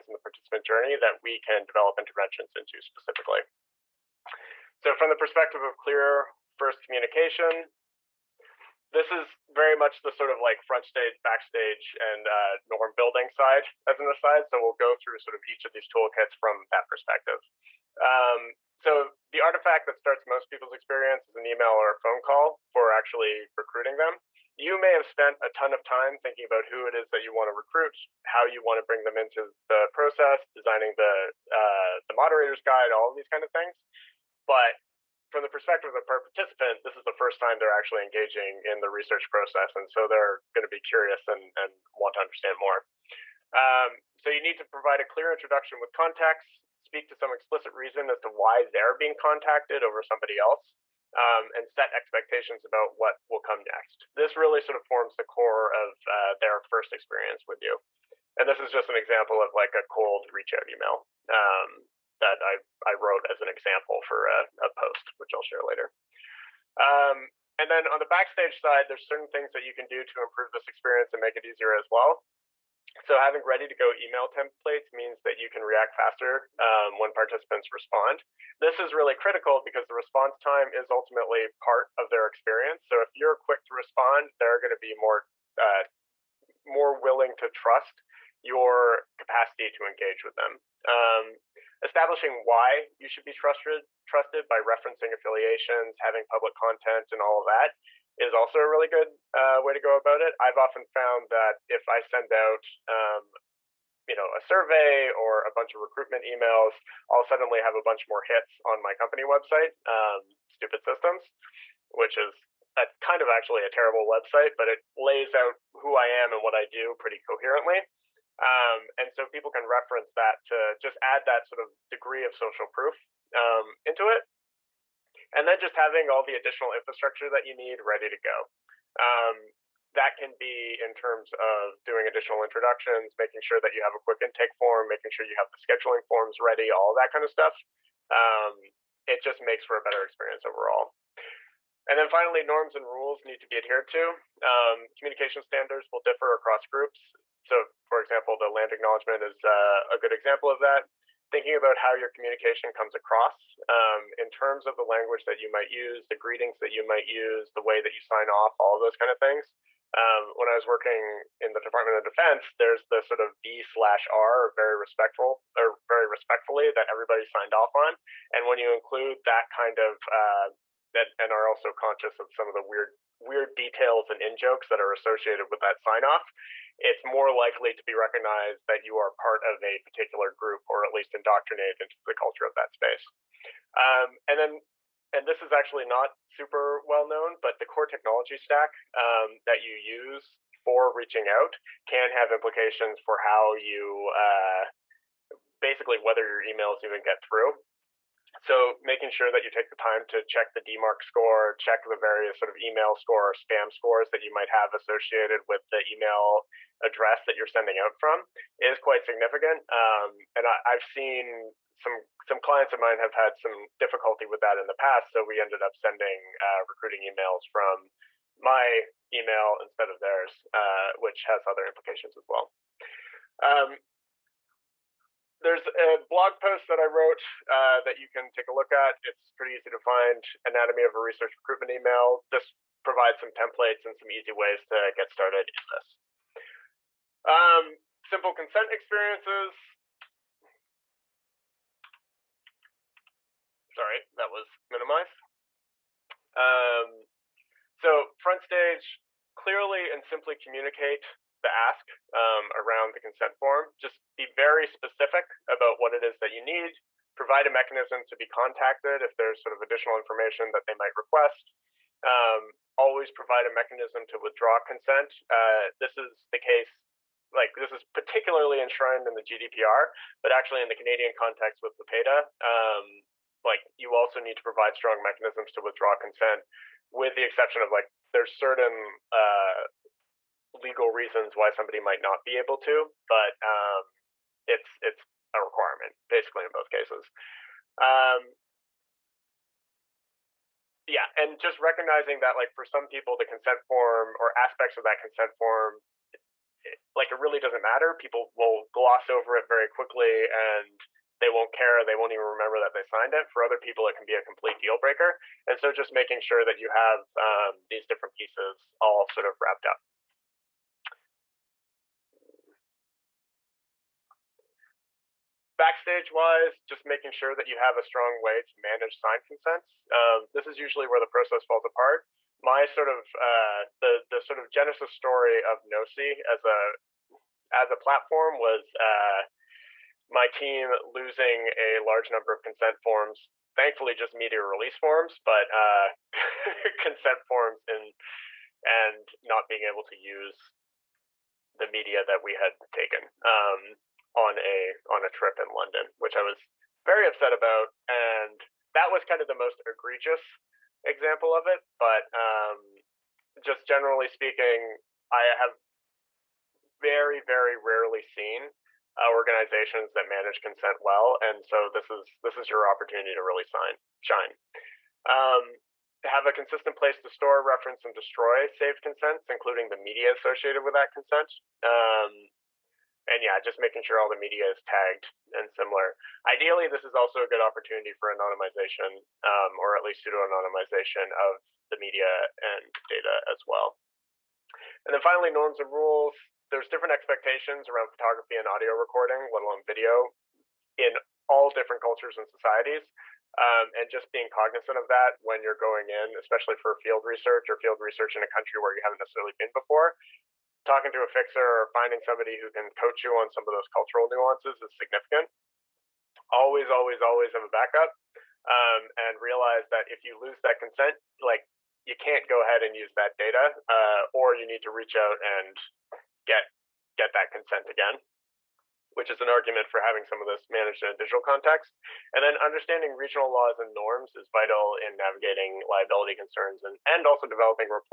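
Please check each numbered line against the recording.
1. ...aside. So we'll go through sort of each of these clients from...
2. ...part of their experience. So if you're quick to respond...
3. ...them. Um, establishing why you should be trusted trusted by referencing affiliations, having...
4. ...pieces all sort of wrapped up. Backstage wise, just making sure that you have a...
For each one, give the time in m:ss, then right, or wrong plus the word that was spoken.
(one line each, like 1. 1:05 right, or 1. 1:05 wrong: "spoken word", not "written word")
1. 0:14 wrong: "toolkits", not "clients"
2. 1:21 right
3. 1:30 right
4. 5:08 right.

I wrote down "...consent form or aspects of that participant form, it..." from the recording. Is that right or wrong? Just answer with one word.
wrong.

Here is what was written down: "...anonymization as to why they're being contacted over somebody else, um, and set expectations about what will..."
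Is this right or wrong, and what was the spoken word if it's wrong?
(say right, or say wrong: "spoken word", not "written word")
wrong: "reason", not "anonymization".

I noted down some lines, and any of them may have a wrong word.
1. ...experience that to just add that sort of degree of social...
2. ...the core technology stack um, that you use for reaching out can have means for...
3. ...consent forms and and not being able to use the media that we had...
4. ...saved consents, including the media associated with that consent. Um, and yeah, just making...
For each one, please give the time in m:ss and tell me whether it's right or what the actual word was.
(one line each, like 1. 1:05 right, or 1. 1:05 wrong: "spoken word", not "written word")
1. 1:59 wrong: "reference", not "experience"
2. 3:07 wrong: "implications", not "means"
3. 5:36 right
4. 6:08 right.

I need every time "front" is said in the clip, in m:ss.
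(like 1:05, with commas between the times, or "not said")
0:10, 4:08.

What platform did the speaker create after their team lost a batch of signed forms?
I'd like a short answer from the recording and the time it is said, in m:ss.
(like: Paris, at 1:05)
Knowsi, at 5:25.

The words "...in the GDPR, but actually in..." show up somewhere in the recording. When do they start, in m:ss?
4:29.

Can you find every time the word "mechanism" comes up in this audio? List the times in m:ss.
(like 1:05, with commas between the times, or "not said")
4:17, 4:23, 4:35.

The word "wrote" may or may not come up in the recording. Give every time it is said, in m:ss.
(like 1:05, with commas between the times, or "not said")
1:02, 3:46.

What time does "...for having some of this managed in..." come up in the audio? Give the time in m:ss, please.
6:59.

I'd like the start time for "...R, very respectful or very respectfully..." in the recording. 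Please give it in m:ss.
2:44.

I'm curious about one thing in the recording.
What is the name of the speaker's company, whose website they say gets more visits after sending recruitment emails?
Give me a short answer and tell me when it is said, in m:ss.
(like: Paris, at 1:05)
Stupid Systems, at 1:50.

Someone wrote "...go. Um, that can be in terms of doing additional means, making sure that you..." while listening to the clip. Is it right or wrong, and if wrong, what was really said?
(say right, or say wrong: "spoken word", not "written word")
wrong: "introductions", not "means".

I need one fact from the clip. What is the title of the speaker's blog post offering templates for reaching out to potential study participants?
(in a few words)
Anatomy of a research recruitment email.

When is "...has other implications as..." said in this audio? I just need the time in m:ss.
3:41.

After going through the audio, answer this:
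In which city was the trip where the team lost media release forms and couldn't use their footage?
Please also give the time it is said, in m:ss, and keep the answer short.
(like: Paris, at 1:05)
London, at 5:45.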